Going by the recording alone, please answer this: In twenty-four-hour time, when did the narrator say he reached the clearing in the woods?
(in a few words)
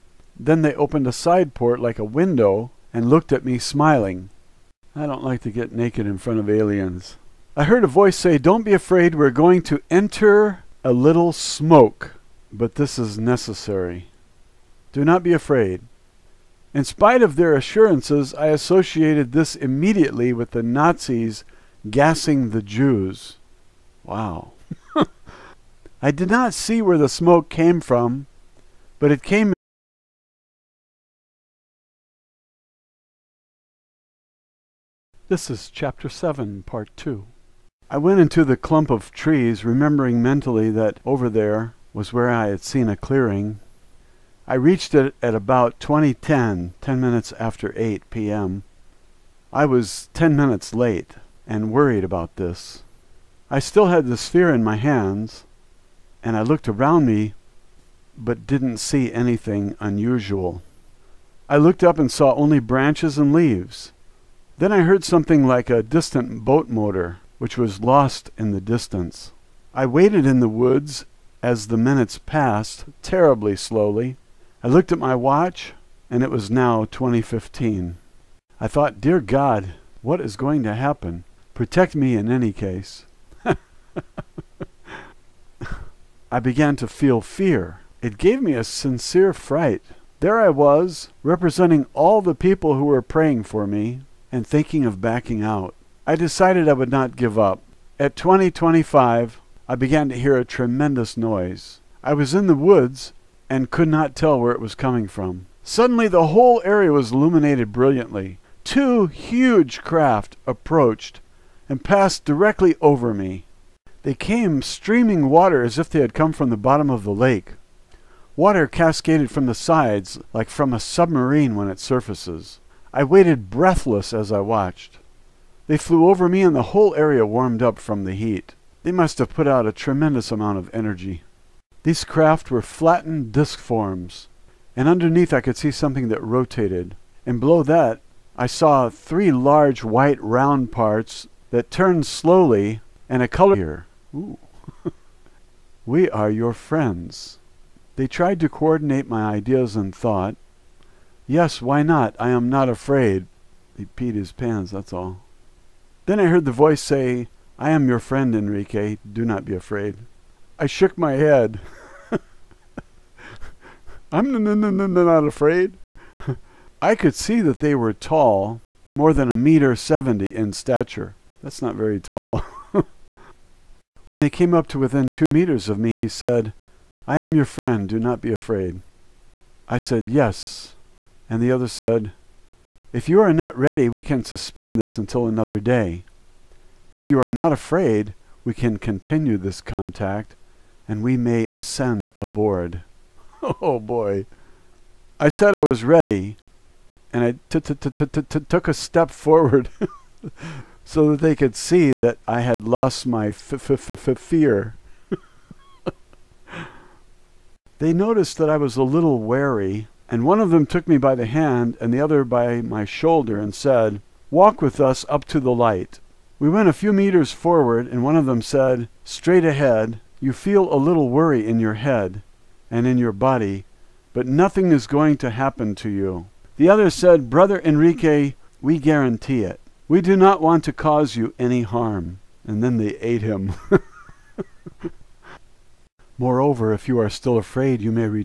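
2010.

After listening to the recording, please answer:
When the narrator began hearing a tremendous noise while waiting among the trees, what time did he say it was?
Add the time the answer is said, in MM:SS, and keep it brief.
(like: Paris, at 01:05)
2025, at 01:38.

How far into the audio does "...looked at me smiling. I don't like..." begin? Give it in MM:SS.
00:03.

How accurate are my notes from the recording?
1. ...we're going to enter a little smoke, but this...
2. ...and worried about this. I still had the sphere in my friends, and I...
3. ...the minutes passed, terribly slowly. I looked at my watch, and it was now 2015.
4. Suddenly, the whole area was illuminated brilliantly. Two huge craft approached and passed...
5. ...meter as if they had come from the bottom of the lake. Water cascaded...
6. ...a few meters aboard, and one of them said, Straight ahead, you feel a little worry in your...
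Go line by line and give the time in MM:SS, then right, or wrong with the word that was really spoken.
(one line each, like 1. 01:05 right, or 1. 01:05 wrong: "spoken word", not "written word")
1. 00:09 right
2. 00:51 wrong: "hands", not "friends"
3. 01:11 right
4. 01:45 right
5. 01:55 wrong: "water", not "meter"
6. 03:36 wrong: "forward", not "aboard".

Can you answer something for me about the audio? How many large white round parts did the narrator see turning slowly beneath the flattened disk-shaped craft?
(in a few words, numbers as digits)
3.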